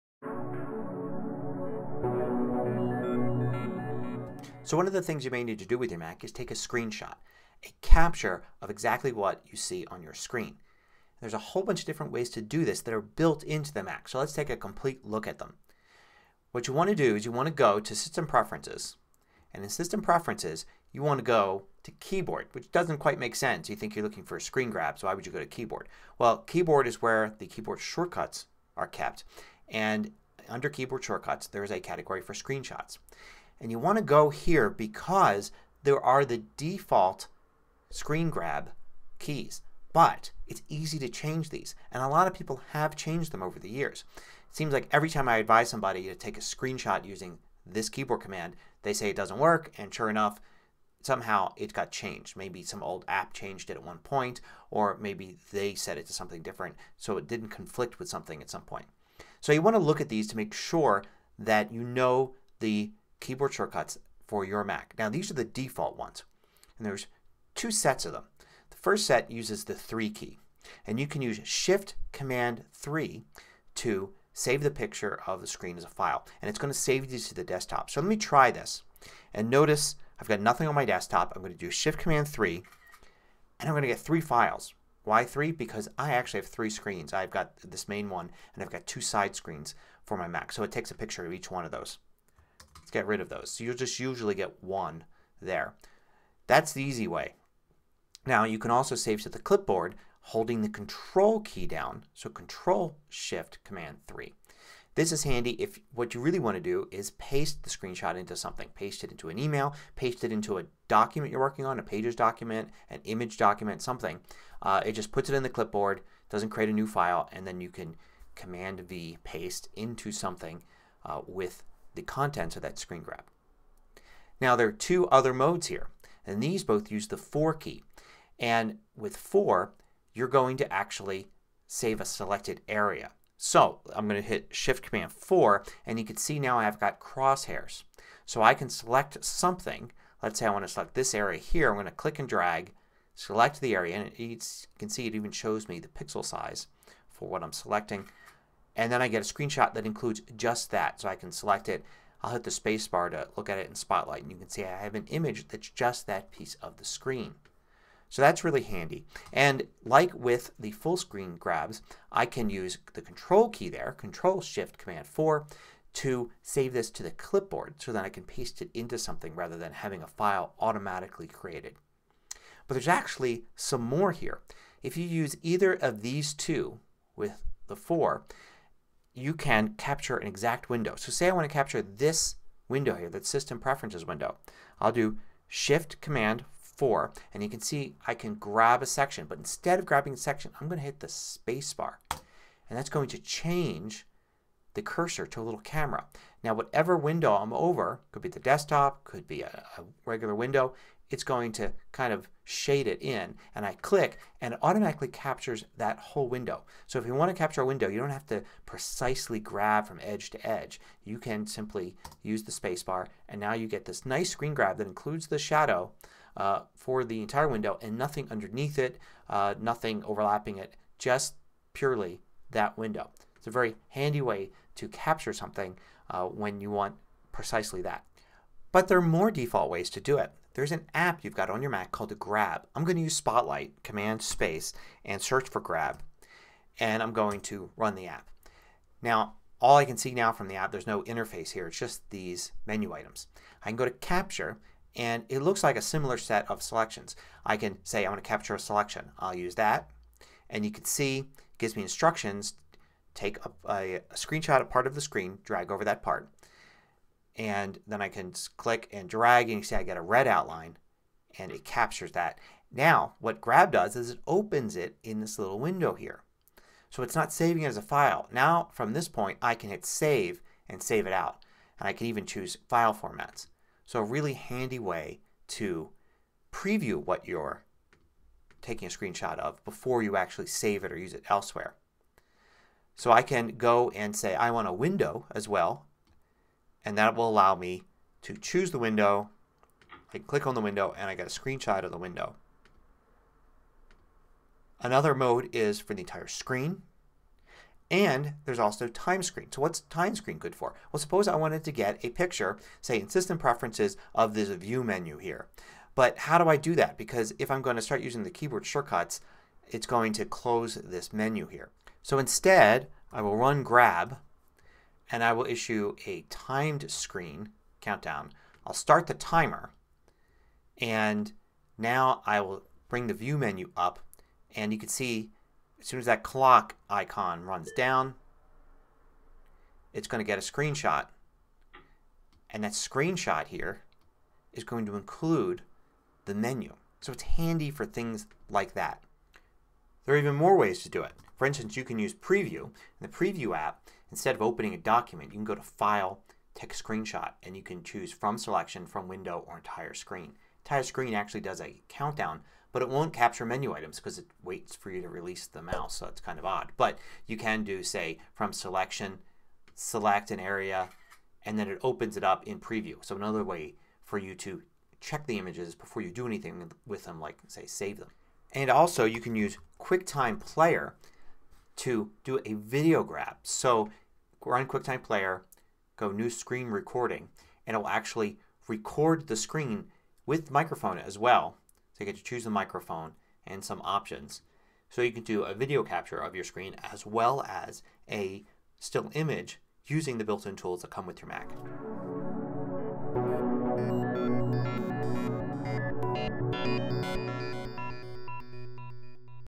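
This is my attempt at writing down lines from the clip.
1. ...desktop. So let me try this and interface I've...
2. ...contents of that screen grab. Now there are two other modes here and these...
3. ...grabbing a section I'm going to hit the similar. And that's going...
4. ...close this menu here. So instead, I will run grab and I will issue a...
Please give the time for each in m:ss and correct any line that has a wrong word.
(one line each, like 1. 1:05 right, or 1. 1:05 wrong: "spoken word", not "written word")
1. 1:17 wrong: "notice", not "interface"
2. 2:02 right
3. 3:09 wrong: "spacebar", not "similar"
4. 5:10 right.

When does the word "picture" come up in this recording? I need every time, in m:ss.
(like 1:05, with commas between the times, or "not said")
1:14, 1:30, 5:02.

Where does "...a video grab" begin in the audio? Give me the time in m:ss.
6:12.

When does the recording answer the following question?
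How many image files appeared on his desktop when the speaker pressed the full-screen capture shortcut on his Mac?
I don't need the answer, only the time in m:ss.
1:23.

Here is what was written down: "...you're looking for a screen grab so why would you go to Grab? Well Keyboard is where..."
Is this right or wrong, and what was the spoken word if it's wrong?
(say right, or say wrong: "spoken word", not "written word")
wrong: "Keyboard", not "Grab".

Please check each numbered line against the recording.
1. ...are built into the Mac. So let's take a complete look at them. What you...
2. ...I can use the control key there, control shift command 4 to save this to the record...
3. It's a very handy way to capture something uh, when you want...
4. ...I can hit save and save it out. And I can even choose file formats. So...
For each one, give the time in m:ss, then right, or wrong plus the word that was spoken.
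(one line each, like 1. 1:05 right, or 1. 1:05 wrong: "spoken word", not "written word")
1. 0:12 right
2. 2:42 wrong: "clipboard", not "record"
3. 3:43 right
4. 4:29 right.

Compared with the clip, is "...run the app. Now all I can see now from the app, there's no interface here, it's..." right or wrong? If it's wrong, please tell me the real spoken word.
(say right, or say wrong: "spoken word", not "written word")
right.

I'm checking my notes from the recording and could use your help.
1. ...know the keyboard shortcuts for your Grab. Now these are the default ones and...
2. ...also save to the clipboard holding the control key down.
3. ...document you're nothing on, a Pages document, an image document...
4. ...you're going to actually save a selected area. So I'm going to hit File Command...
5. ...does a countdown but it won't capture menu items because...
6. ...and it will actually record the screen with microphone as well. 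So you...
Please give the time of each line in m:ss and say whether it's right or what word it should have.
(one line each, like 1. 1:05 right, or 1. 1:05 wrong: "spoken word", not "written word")
1. 1:01 wrong: "Mac", not "Grab"
2. 1:38 right
3. 1:50 wrong: "working", not "nothing"
4. 2:10 wrong: "Shift", not "File"
5. 5:51 right
6. 6:17 right.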